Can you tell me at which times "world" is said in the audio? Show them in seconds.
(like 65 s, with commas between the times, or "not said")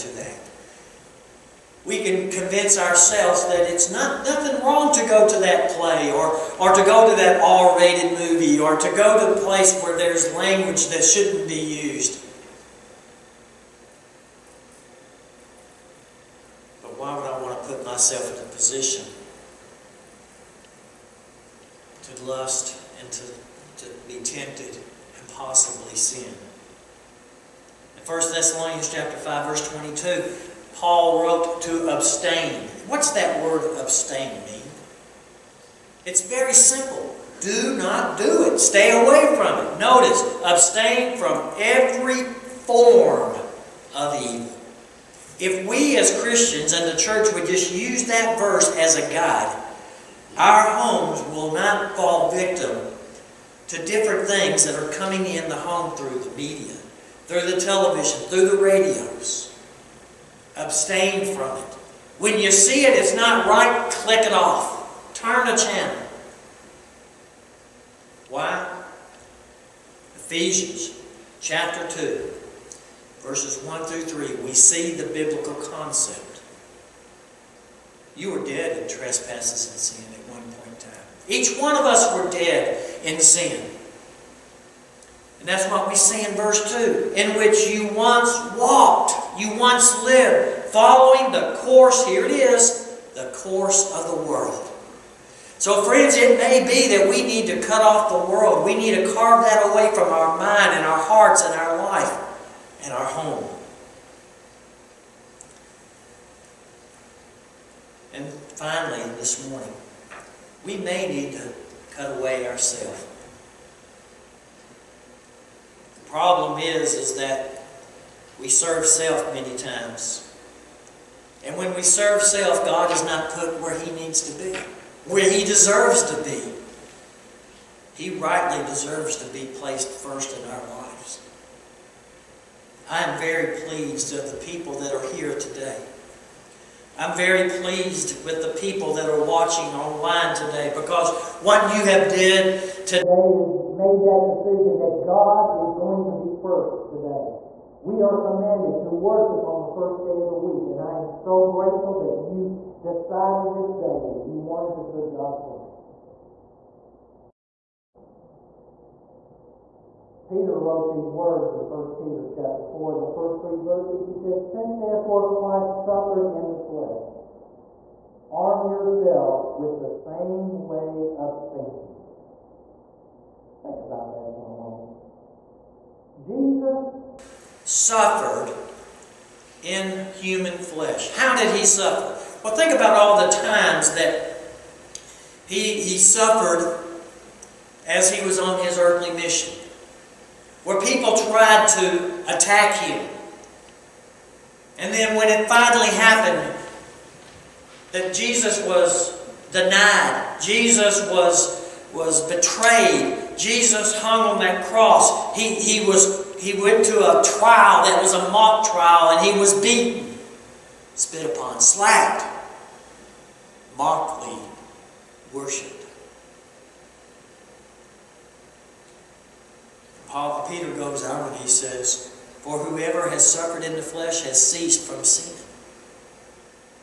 94 s, 98 s.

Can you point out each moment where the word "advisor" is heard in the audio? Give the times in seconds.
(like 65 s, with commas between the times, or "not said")
not said.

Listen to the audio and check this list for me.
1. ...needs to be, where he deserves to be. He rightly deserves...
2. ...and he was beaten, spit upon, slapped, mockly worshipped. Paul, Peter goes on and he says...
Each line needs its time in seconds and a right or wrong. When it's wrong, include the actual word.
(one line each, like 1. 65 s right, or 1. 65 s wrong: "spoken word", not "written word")
1. 123 s right
2. 209 s right.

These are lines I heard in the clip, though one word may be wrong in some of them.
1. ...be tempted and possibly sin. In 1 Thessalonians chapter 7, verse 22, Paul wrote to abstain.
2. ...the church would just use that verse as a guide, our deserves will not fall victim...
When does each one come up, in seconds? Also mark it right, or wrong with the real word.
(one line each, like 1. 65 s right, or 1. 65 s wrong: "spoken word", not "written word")
1. 24 s wrong: "5", not "7"
2. 46 s wrong: "homes", not "deserves".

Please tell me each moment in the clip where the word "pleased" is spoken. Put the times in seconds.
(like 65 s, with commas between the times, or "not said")
133 s, 137 s.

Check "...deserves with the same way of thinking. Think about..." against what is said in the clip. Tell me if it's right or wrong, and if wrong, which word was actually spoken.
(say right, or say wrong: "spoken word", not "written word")
wrong: "yourselves", not "deserves".